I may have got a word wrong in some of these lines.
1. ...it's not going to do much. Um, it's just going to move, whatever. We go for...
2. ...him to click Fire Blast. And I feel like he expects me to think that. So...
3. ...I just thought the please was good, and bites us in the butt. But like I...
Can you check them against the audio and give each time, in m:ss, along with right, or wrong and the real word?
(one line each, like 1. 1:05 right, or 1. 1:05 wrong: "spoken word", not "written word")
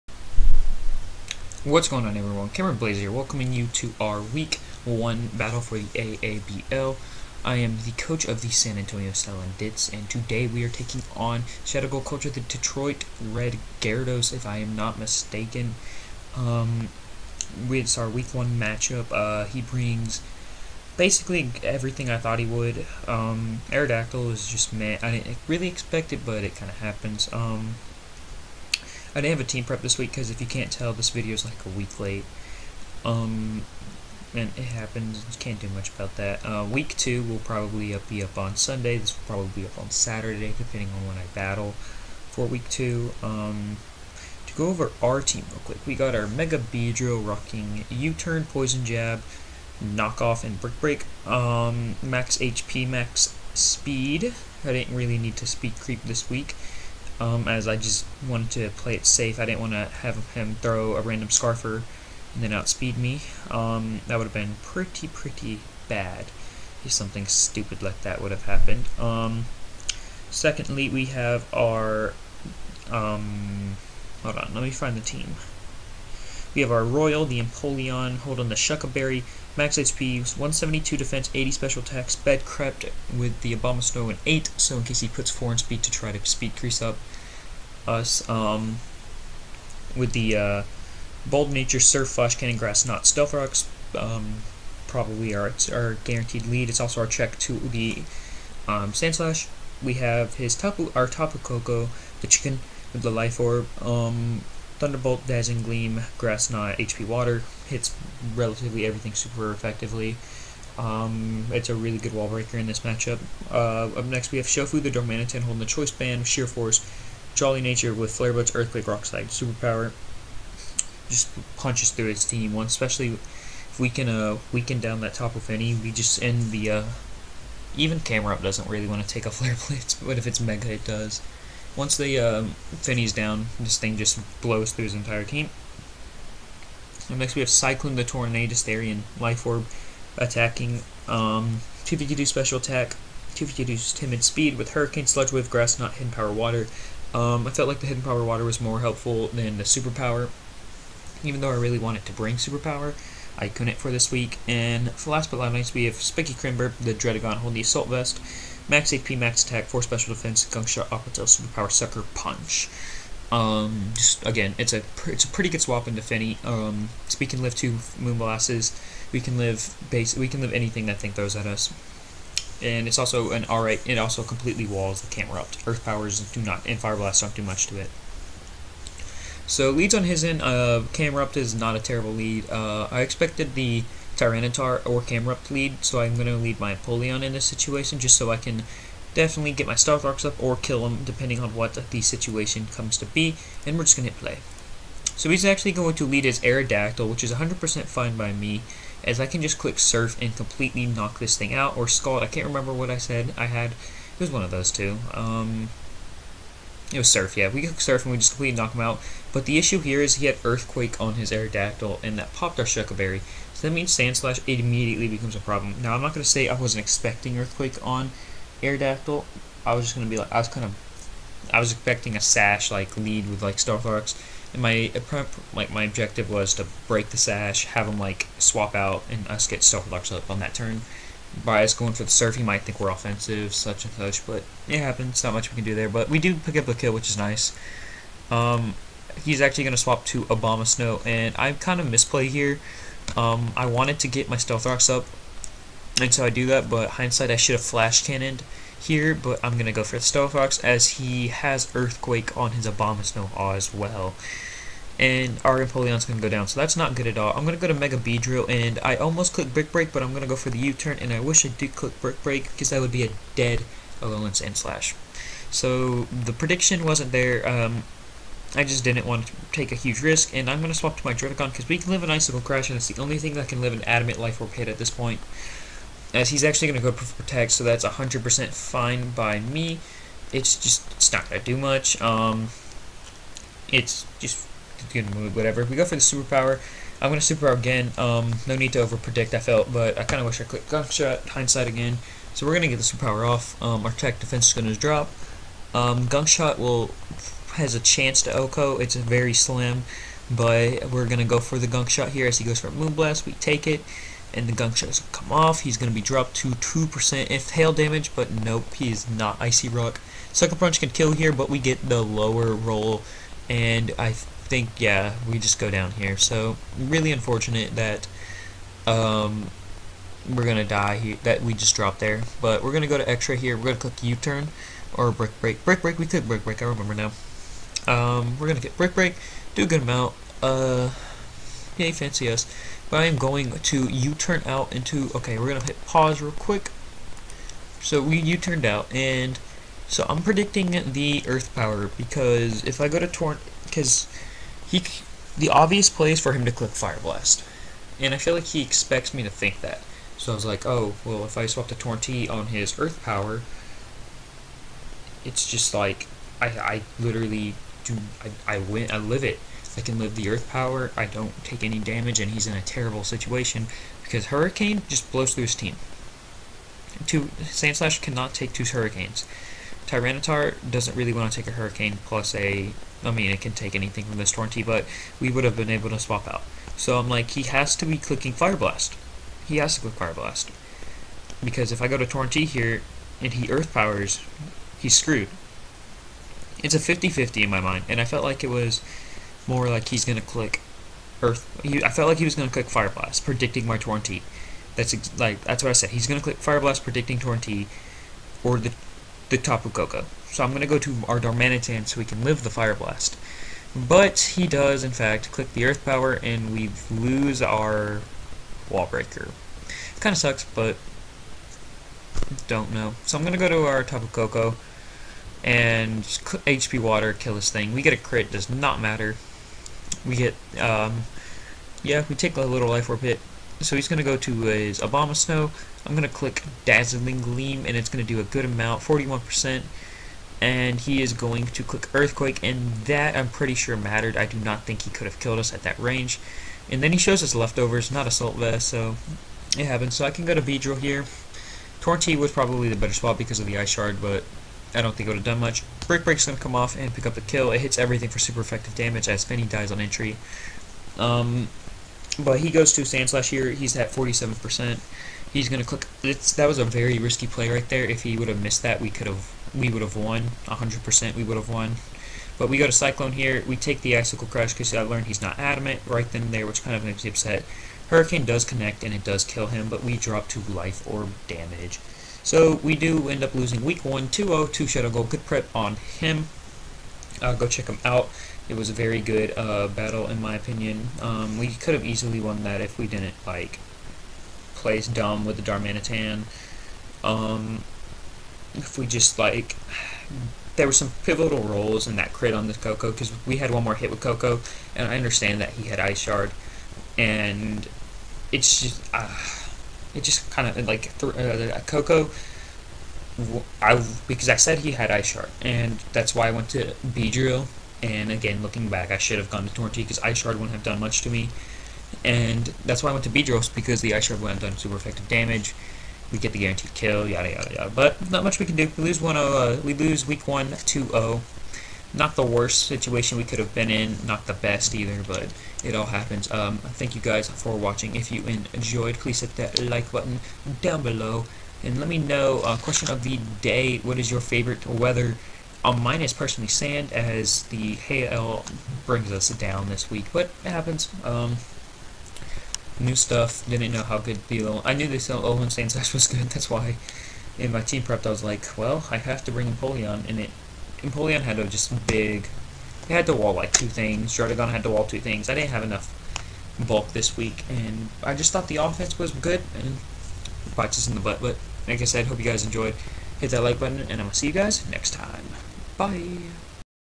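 1. 4:40 right
2. 5:46 right
3. 9:18 wrong: "offense", not "please".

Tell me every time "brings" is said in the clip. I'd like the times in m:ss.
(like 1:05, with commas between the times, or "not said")
0:19, 2:32, 8:58, 9:09.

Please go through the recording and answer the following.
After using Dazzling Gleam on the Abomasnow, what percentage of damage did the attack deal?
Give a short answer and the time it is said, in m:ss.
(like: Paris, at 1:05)
41%, at 7:08.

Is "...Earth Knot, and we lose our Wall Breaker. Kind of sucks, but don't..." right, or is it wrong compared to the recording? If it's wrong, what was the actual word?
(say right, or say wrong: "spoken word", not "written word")
wrong: "Power", not "Knot".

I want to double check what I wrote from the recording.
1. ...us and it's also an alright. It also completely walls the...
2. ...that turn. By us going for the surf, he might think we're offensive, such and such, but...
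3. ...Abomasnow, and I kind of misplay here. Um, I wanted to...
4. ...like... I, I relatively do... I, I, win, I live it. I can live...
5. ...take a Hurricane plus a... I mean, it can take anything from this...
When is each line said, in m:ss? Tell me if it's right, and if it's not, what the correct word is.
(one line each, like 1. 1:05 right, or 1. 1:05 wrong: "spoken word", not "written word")
1. 2:51 right
2. 3:50 right
3. 4:00 right
4. 5:55 wrong: "literally", not "relatively"
5. 6:11 right.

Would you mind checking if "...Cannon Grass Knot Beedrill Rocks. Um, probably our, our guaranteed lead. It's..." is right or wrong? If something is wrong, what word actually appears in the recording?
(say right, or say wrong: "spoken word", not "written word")
wrong: "Stealth", not "Beedrill".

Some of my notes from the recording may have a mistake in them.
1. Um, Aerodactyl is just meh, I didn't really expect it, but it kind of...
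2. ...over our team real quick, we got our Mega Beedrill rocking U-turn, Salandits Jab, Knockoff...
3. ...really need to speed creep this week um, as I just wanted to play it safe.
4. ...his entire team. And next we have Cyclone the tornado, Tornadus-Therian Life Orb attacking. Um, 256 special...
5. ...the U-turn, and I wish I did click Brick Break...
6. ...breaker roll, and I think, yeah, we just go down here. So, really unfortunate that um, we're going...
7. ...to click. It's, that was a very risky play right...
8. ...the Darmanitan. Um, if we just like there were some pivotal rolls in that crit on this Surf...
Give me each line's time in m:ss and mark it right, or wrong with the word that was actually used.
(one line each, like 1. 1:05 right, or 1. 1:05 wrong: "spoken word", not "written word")
1. 0:23 right
2. 0:44 wrong: "Poison", not "Salandits"
3. 0:54 right
4. 2:14 wrong: "252", not "256"
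5. 4:20 right
6. 5:12 wrong: "lower", not "breaker"
7. 7:35 right
8. 8:05 wrong: "Koko", not "Surf".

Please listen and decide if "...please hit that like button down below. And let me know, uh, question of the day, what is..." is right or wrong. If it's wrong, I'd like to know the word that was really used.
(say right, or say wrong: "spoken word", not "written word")
right.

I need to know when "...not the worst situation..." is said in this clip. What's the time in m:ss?
8:41.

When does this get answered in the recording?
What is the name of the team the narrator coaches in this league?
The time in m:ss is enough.
0:08.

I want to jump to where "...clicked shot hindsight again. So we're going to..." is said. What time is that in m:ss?
4:50.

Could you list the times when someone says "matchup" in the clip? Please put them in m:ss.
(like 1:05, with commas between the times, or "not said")
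0:18, 1:52.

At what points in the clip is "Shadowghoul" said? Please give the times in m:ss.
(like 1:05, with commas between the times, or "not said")
0:11, 7:54.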